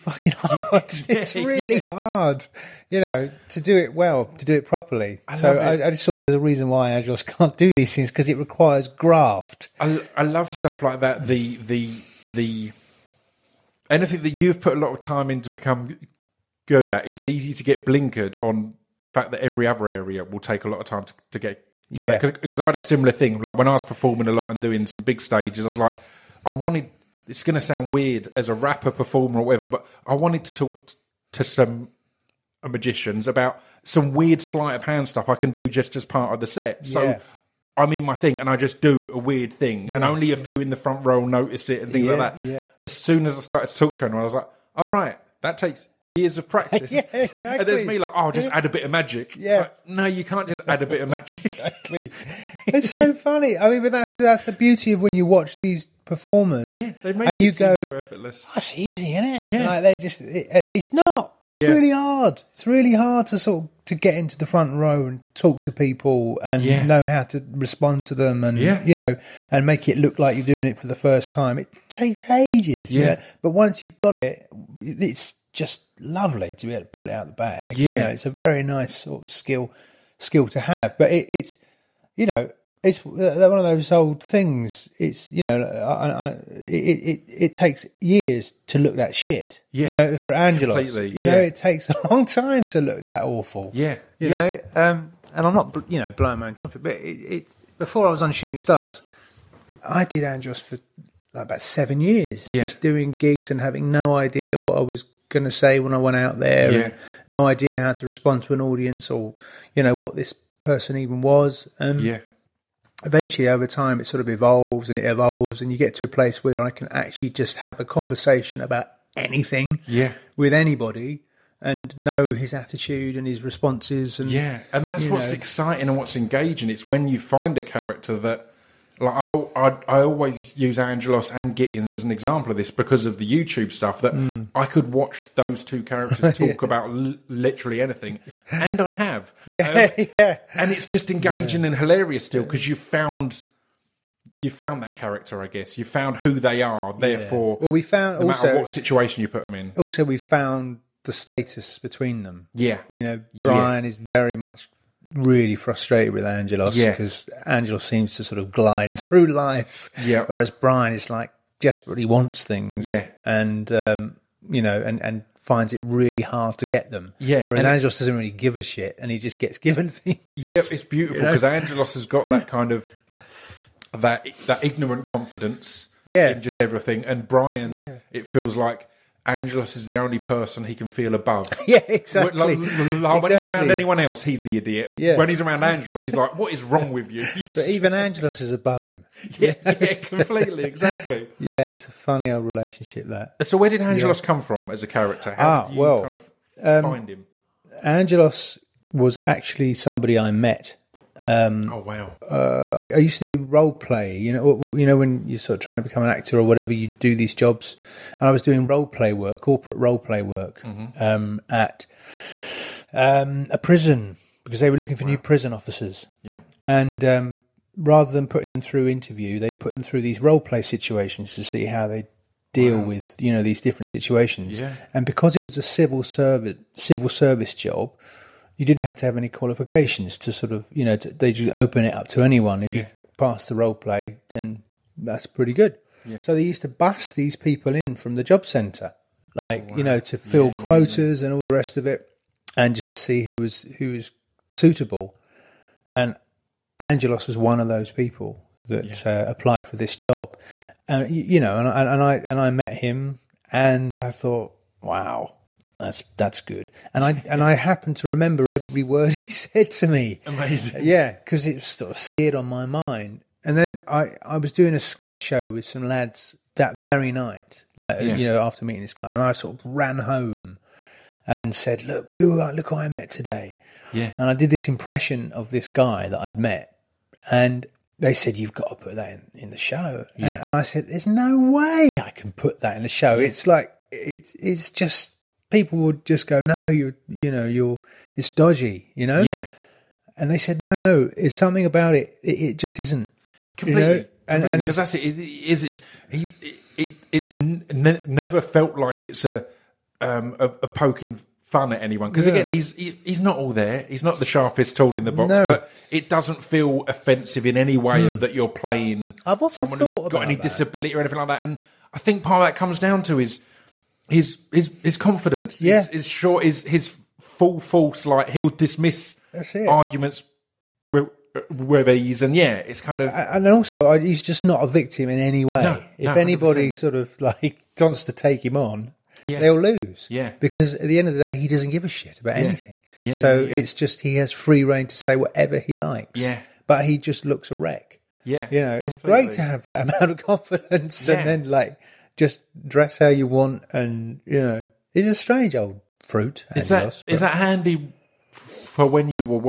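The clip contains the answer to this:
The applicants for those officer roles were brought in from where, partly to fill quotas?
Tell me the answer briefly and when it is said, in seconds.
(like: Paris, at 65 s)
The job centre, at 238 s.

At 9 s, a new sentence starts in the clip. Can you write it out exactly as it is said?
I, I love stuff like that.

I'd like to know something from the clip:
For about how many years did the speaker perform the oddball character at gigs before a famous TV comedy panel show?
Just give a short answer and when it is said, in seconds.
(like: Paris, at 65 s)
7, at 101 s.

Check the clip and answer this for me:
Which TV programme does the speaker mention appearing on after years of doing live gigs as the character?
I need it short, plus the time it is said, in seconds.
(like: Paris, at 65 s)
Shooting Stars, at 98 s.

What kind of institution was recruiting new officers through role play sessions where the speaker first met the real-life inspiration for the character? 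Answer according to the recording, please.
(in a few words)
A prison.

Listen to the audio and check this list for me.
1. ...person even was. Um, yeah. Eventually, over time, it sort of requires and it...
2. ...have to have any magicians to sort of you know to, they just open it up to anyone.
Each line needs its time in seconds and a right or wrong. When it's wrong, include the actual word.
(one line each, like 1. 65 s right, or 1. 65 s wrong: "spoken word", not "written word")
1. 110 s wrong: "evolves", not "requires"
2. 228 s wrong: "qualifications", not "magicians".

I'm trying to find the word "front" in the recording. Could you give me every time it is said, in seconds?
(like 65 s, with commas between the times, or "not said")
40 s, 64 s.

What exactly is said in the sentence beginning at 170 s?
Yeah, it's beautiful because you know?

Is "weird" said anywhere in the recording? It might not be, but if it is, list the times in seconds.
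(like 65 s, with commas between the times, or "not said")
27 s, 34 s, 39 s.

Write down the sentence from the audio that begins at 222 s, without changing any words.
with you know these different situations.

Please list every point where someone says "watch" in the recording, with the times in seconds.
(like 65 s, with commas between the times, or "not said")
55 s, 134 s.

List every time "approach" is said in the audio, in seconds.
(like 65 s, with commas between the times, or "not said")
not said.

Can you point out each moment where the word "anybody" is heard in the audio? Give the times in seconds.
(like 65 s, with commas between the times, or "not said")
120 s, 326 s.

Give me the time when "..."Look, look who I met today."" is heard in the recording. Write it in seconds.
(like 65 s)
271 s.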